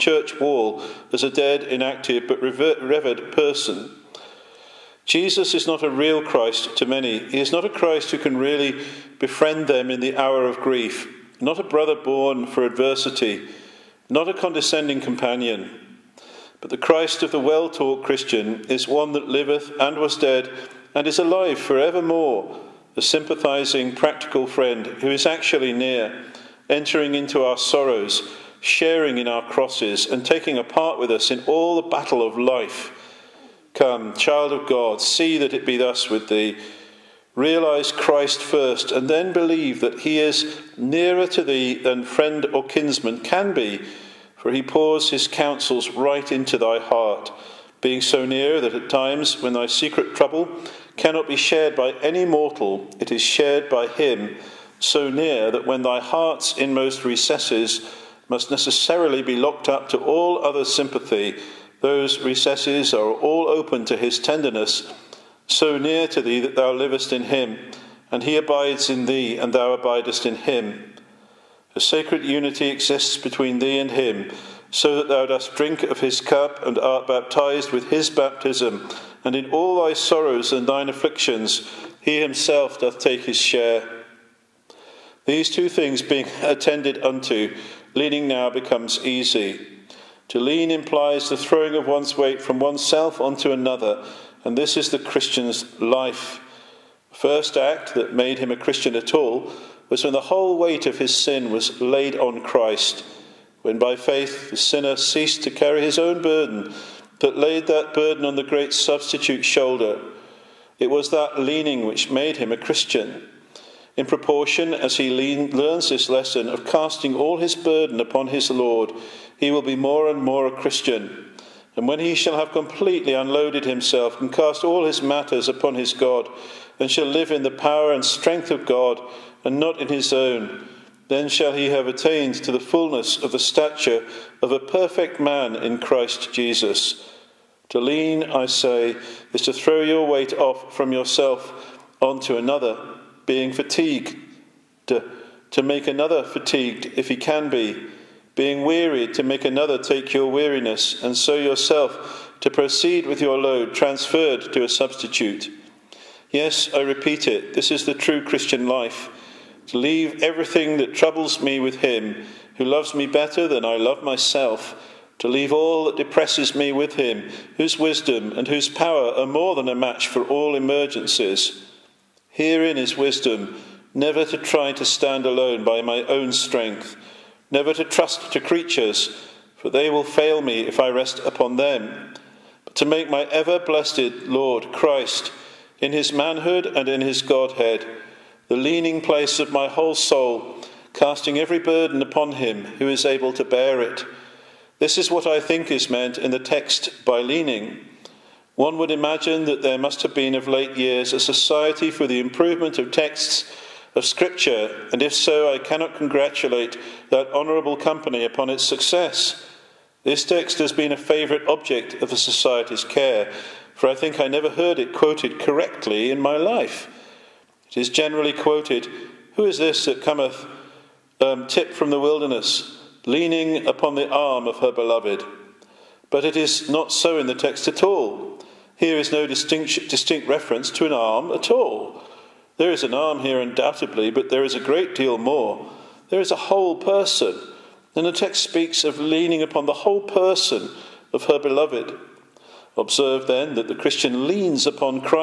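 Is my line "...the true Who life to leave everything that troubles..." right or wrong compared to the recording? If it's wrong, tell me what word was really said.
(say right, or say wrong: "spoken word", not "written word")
wrong: "Christian", not "Who".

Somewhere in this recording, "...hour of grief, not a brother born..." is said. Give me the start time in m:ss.
0:10.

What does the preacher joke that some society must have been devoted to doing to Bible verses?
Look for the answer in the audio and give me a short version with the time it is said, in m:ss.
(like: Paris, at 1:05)
improvement of texts, at 3:22.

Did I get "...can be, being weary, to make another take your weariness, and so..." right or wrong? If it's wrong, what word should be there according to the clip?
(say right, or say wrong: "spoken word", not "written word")
right.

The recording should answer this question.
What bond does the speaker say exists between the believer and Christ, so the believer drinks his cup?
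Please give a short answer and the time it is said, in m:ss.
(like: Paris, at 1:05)
A sacred unity, at 1:11.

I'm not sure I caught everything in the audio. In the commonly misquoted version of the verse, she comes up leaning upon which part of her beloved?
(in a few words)
the arm.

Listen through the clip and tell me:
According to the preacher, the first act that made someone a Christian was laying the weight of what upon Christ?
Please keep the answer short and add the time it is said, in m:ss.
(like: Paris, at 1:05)
his sin, at 1:40.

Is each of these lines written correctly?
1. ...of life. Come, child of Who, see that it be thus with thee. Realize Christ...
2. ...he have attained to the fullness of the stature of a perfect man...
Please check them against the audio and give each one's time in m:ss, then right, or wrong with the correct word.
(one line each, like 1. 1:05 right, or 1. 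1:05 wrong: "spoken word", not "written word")
1. 0:32 wrong: "God", not "Who"
2. 2:11 right.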